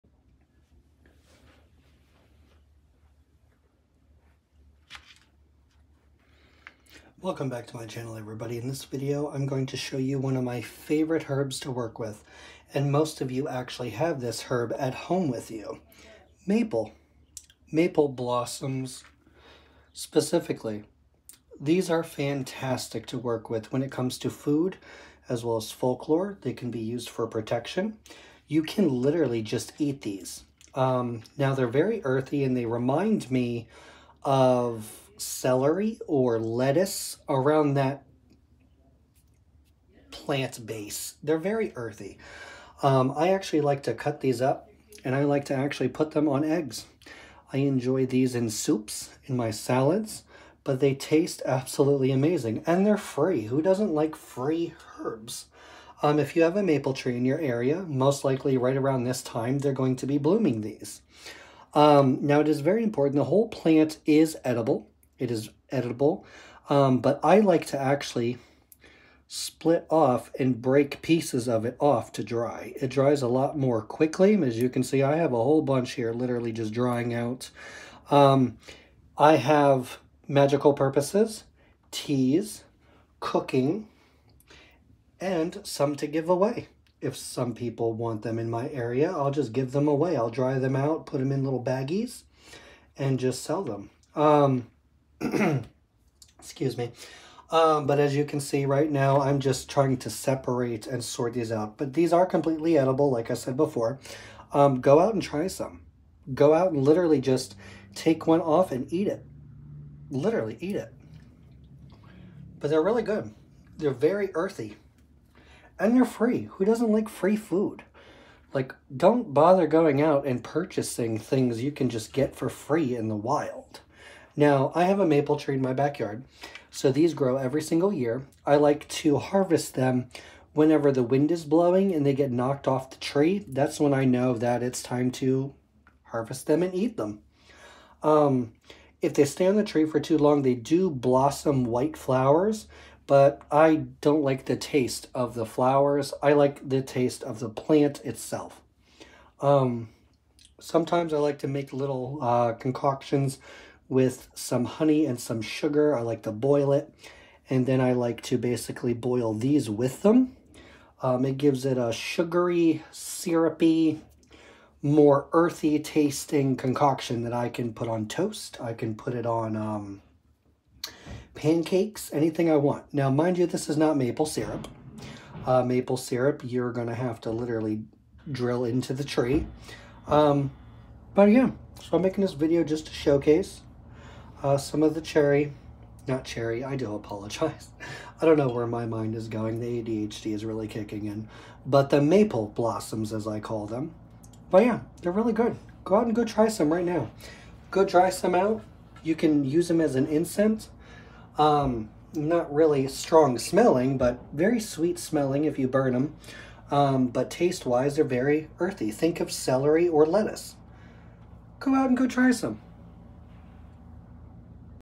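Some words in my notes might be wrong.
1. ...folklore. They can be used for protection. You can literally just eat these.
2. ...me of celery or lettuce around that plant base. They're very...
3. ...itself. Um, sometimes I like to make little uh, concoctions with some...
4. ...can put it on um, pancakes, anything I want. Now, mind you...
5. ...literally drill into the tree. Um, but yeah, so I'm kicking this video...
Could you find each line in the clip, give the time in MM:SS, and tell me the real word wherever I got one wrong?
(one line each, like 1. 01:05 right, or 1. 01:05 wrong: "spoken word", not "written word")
1. 00:25 right
2. 00:33 right
3. 02:28 right
4. 02:48 right
5. 02:57 wrong: "making", not "kicking".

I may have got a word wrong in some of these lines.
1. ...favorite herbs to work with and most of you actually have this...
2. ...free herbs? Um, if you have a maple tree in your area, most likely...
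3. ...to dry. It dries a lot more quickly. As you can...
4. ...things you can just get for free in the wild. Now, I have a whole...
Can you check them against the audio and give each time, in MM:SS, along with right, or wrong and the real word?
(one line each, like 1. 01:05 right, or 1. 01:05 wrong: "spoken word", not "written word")
1. 00:10 right
2. 00:54 right
3. 01:12 right
4. 02:01 wrong: "maple", not "whole".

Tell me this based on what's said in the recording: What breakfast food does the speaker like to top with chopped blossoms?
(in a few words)
eggs.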